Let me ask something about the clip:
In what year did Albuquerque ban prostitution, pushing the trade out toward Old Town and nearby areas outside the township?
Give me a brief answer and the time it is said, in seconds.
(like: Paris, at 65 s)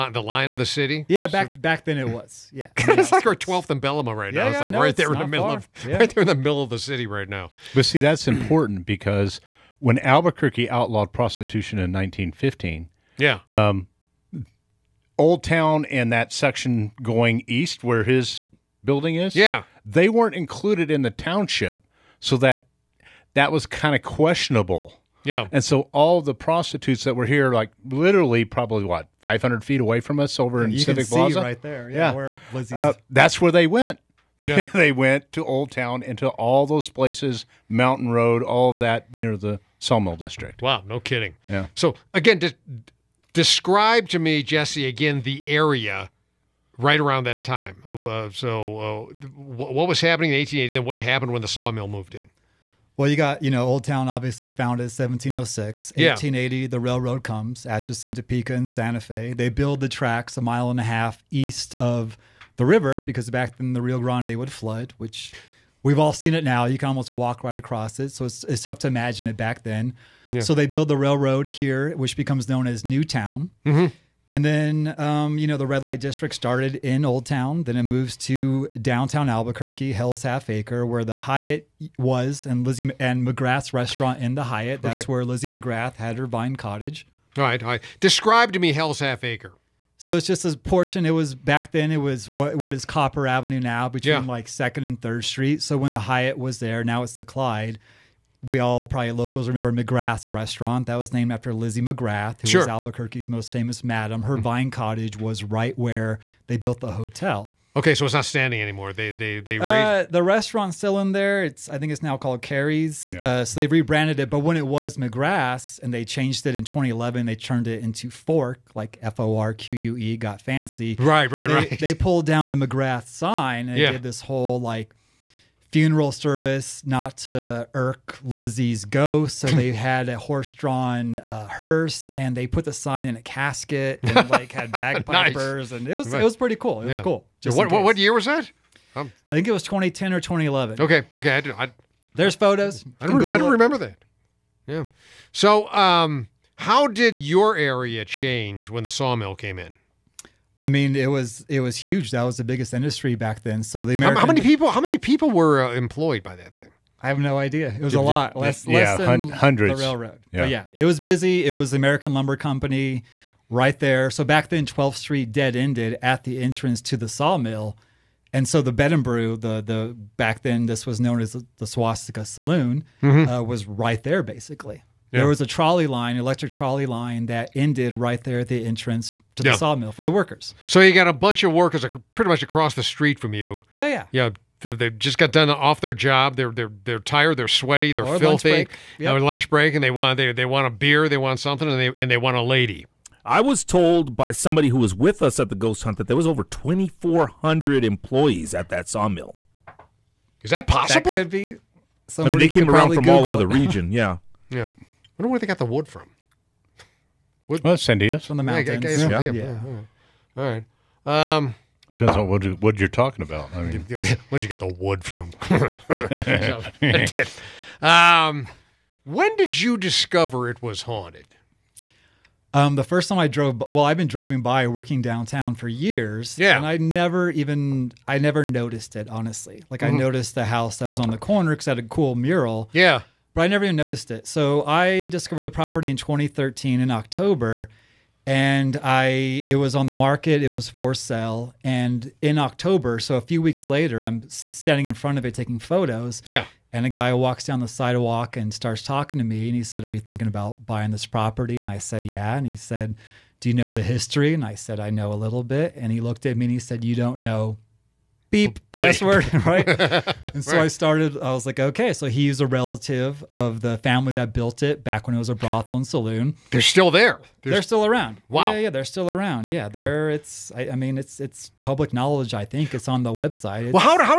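1915, at 11 s.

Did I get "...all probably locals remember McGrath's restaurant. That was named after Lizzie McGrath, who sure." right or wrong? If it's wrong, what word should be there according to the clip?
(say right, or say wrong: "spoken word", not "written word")
right.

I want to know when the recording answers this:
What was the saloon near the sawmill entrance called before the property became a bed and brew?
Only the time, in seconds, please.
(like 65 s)
171 s.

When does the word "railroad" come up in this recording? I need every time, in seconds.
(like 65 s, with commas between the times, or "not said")
56 s, 70 s, 159 s.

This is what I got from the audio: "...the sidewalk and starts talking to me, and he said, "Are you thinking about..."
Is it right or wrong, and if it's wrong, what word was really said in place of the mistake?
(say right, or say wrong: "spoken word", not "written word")
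right.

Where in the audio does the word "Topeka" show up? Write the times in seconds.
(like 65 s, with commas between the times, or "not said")
58 s.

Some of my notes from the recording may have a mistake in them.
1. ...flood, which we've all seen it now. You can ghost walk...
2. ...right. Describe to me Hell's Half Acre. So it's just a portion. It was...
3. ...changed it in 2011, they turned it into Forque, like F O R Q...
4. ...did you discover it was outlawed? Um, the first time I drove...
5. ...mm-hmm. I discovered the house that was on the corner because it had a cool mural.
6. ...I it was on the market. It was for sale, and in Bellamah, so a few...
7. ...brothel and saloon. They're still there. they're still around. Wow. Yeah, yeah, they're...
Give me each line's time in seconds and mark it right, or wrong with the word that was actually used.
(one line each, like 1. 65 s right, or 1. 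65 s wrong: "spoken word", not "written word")
1. 64 s wrong: "almost", not "ghost"
2. 87 s right
3. 116 s right
4. 219 s wrong: "haunted", not "outlawed"
5. 229 s wrong: "noticed", not "discovered"
6. 238 s wrong: "October", not "Bellamah"
7. 265 s right.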